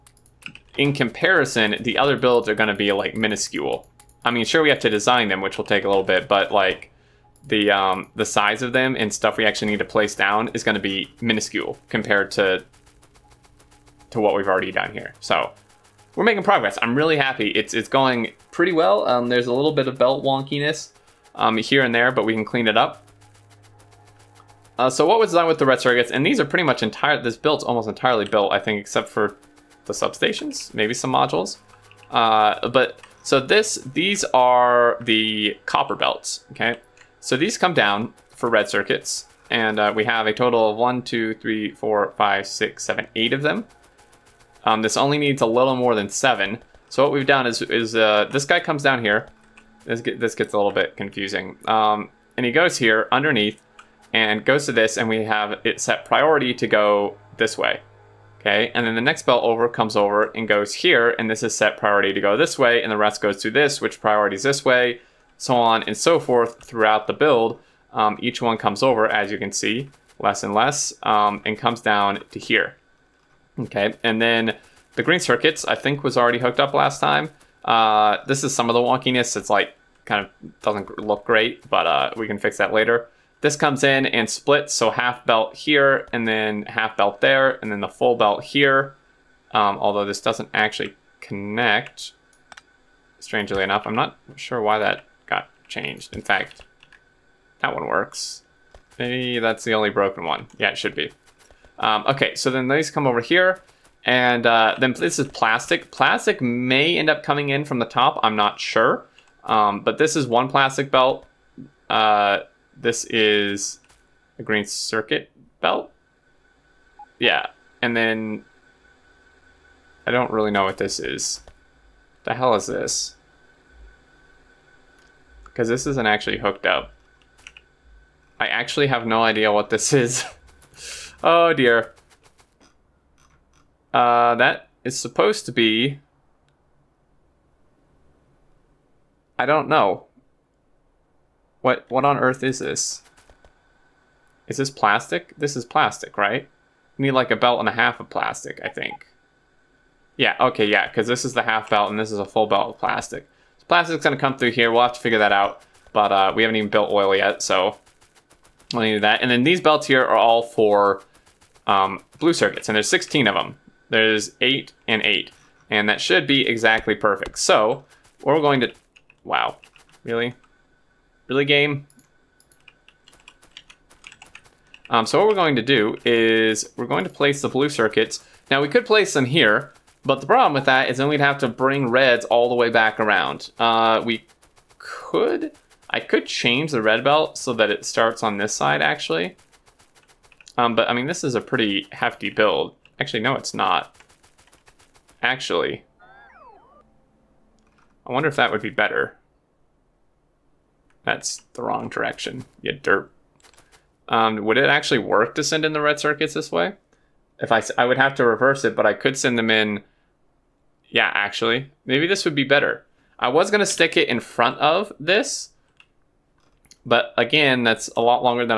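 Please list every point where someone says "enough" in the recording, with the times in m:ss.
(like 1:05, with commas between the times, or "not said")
1:33.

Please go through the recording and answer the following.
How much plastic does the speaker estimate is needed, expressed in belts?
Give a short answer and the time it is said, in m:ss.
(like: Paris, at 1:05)
A belt and a half, at 2:27.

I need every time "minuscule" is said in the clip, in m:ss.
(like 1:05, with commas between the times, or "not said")
0:03, 0:11.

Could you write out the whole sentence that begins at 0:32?
Uh, but so this, these are the copper belts, okay?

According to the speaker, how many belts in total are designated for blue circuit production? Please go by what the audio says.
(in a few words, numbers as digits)
16.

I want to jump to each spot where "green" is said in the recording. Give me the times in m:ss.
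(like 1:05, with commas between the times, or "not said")
1:15, 1:54.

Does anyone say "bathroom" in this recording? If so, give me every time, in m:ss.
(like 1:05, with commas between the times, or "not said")
not said.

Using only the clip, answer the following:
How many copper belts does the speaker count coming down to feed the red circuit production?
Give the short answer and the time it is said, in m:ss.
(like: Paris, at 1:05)
8, at 0:43.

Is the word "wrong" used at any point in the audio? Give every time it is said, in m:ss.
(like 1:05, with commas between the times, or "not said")
3:21.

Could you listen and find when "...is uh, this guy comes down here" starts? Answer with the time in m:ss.
0:47.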